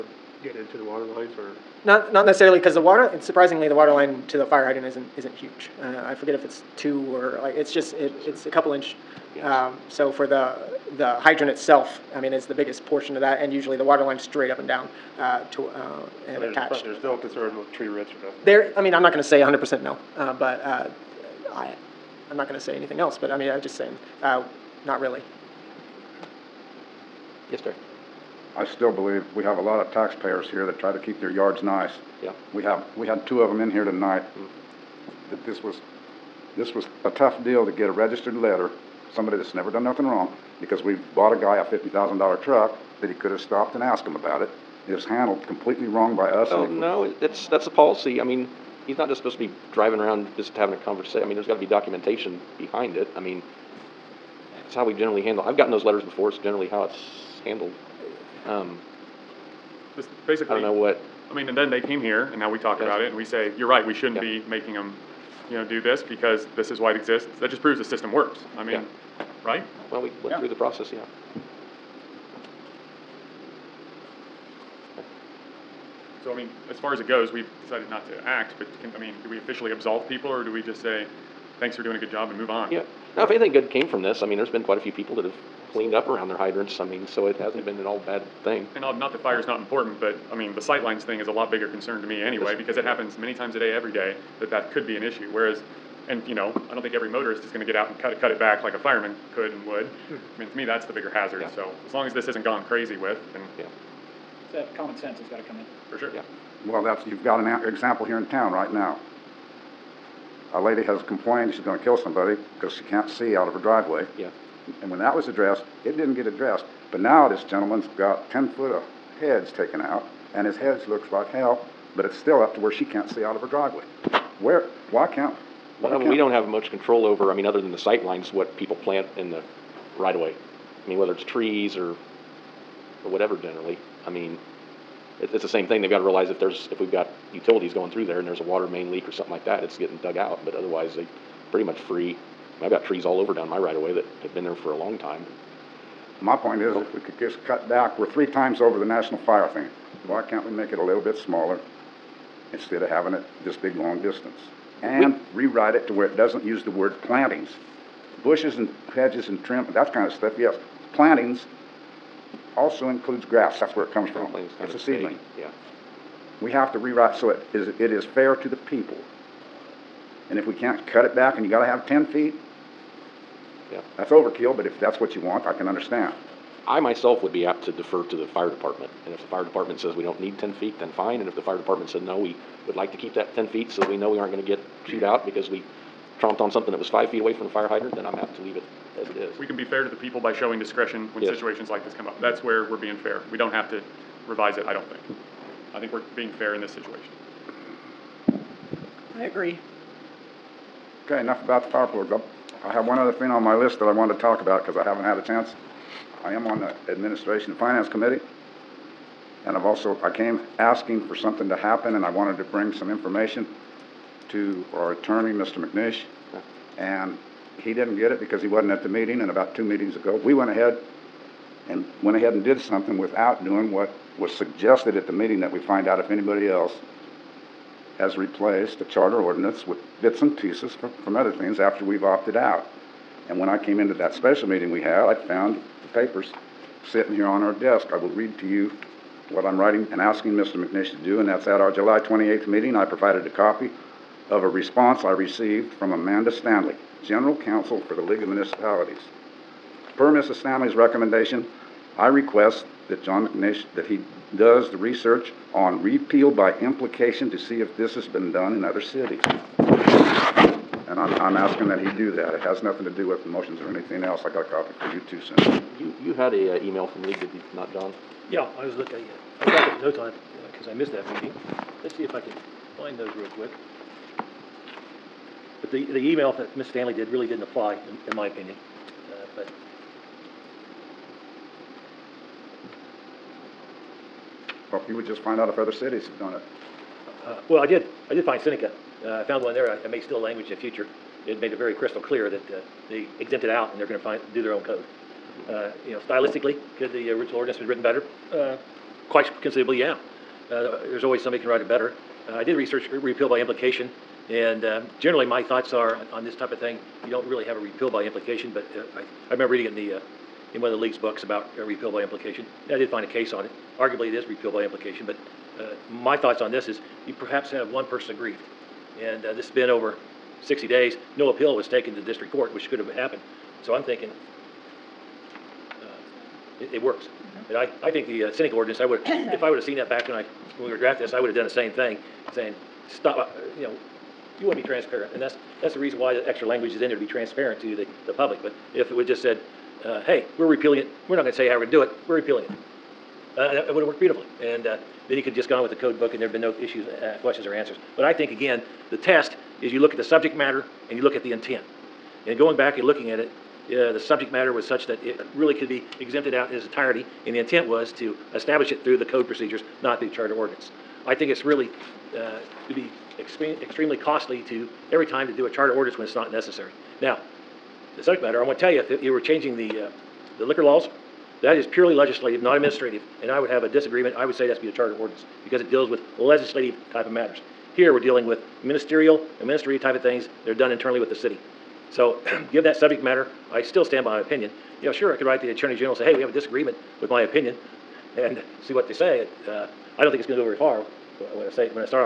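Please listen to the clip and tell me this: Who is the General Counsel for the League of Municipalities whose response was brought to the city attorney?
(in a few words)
Amanda Stanley.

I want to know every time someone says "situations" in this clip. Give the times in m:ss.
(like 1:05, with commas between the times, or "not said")
3:11, 3:16.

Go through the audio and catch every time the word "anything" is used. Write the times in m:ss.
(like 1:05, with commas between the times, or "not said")
0:22, 1:23, 4:23.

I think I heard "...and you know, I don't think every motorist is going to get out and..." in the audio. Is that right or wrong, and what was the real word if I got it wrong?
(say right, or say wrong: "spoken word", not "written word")
right.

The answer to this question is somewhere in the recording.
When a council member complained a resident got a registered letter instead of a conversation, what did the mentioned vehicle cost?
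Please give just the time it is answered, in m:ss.
0:41.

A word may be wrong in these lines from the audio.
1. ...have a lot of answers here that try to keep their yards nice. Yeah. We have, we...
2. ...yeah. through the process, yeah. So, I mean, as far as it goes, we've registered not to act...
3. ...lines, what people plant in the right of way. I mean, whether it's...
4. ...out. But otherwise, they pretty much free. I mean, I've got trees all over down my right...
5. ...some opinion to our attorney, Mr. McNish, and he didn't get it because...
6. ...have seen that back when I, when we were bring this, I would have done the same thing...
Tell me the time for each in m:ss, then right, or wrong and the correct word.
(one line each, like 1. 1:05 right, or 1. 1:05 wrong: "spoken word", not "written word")
1. 0:29 wrong: "taxpayers", not "answers"
2. 1:10 wrong: "decided", not "registered"
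3. 2:08 right
4. 2:20 right
5. 3:32 wrong: "information", not "opinion"
6. 5:29 wrong: "drafting", not "bring".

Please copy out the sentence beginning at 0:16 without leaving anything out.
There's no concern with tree roots or nothing.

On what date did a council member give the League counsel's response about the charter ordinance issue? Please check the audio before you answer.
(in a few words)
July 28th.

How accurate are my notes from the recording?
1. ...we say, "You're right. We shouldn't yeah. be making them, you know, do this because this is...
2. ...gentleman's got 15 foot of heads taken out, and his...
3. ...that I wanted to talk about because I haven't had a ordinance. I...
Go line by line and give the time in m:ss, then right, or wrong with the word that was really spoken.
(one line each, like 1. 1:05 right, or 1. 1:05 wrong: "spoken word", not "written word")
1. 1:03 right
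2. 1:57 wrong: "10", not "15"
3. 3:23 wrong: "chance", not "ordinance".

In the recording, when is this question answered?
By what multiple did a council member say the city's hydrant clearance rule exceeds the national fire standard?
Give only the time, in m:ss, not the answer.
2:28.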